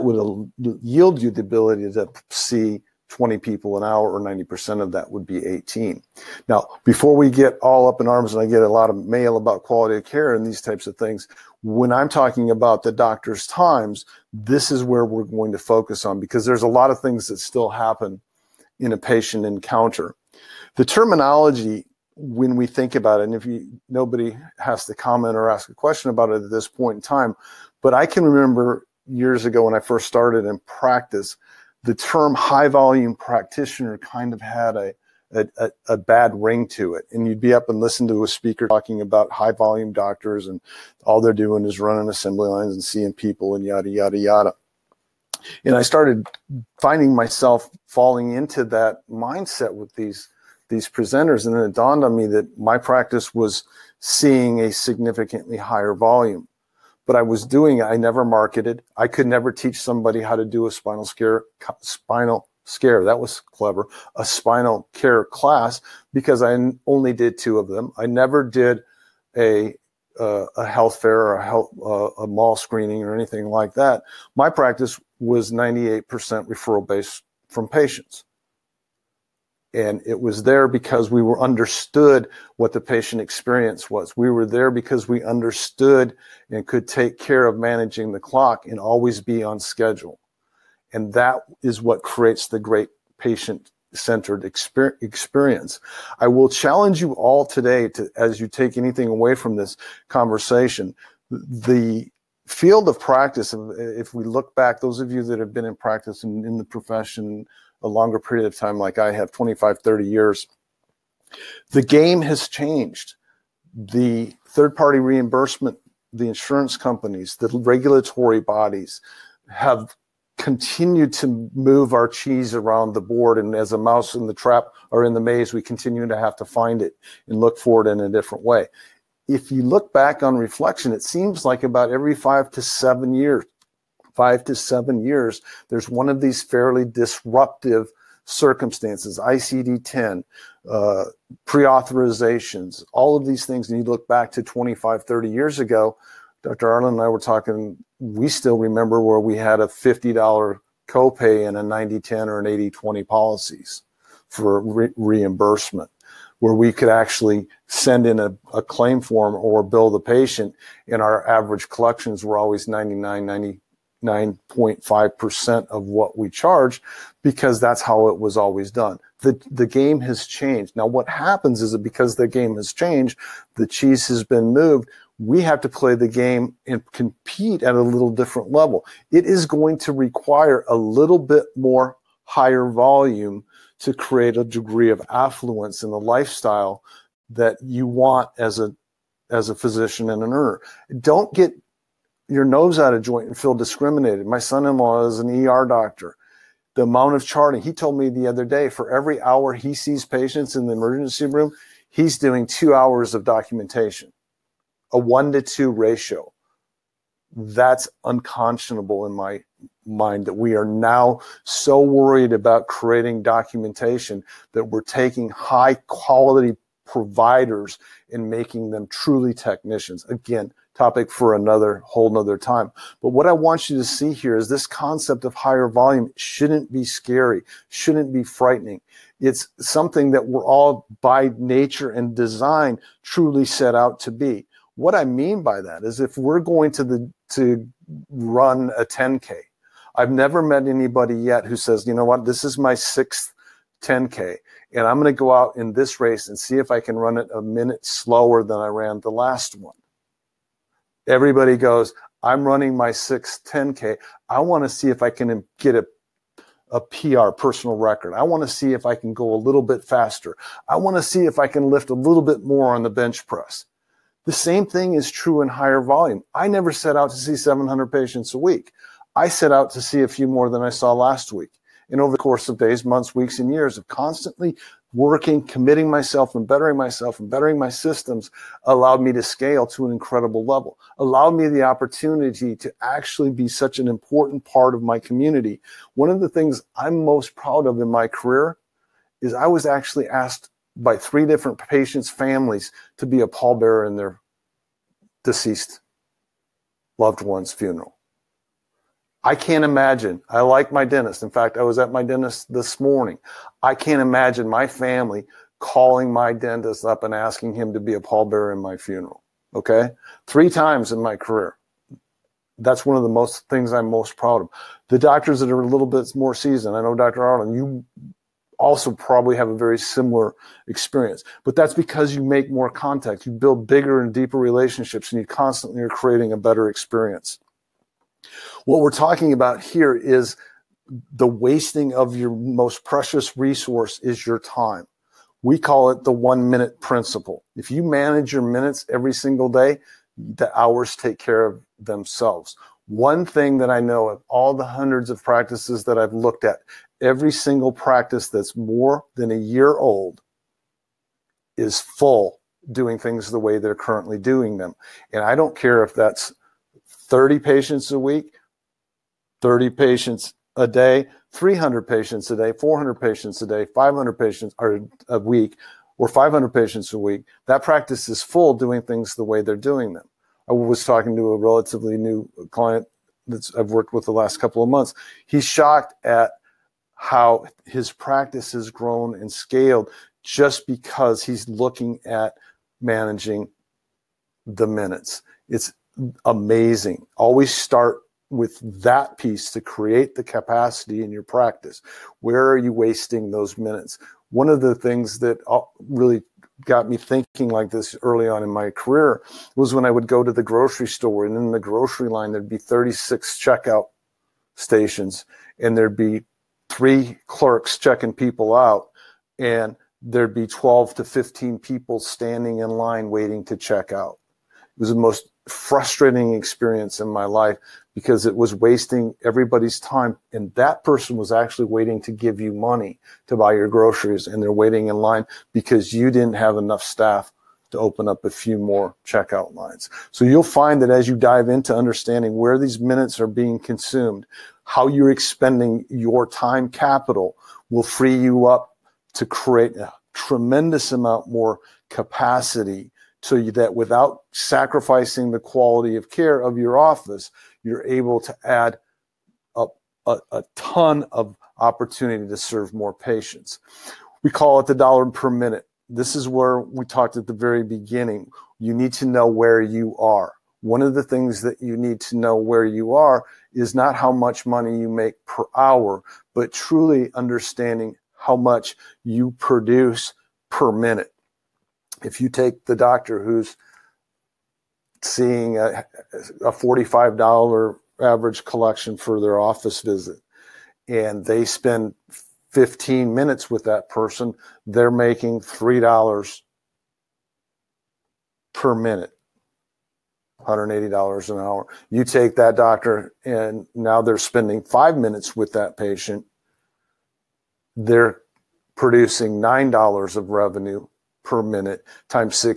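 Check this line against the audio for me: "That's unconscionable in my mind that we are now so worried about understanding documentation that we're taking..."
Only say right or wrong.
wrong.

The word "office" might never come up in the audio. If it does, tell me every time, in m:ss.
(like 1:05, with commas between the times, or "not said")
7:26, 7:59.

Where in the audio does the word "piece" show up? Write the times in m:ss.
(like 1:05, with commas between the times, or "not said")
6:29.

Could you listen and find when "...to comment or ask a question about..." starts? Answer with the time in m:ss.
0:24.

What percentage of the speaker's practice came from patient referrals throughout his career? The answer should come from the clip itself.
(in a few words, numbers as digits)
98%.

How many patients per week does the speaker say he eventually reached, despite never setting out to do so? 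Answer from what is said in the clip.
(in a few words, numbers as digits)
700.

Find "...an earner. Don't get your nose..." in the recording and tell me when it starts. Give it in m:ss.
3:10.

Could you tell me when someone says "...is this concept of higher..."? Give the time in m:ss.
3:44.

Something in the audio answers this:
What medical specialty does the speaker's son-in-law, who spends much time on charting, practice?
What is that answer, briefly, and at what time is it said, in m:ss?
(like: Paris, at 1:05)
ER doctor, at 3:15.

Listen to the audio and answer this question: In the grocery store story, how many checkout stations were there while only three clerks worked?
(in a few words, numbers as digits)
36.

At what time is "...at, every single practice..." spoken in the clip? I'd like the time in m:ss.
5:46.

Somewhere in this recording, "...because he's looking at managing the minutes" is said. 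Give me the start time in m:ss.
6:20.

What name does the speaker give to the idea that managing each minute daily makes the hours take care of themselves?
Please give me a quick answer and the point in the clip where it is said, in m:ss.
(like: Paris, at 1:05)
one minute principle, at 5:36.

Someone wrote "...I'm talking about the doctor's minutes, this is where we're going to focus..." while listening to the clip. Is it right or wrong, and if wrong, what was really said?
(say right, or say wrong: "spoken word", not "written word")
wrong: "times", not "minutes".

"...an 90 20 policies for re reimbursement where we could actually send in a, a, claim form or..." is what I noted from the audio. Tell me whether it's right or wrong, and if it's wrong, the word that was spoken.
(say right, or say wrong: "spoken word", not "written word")
wrong: "80", not "90".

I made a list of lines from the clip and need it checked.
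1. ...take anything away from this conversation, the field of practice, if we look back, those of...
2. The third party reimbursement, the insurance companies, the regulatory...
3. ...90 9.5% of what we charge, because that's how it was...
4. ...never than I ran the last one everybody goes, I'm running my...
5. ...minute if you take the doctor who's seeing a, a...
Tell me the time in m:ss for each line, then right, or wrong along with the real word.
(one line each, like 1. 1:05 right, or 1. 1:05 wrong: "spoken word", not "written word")
1. 1:38 right
2. 1:53 right
3. 2:43 right
4. 4:07 wrong: "slower", not "never"
5. 7:50 right.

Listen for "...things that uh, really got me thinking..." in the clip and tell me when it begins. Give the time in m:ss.
6:34.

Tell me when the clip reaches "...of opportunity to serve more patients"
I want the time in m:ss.
7:31.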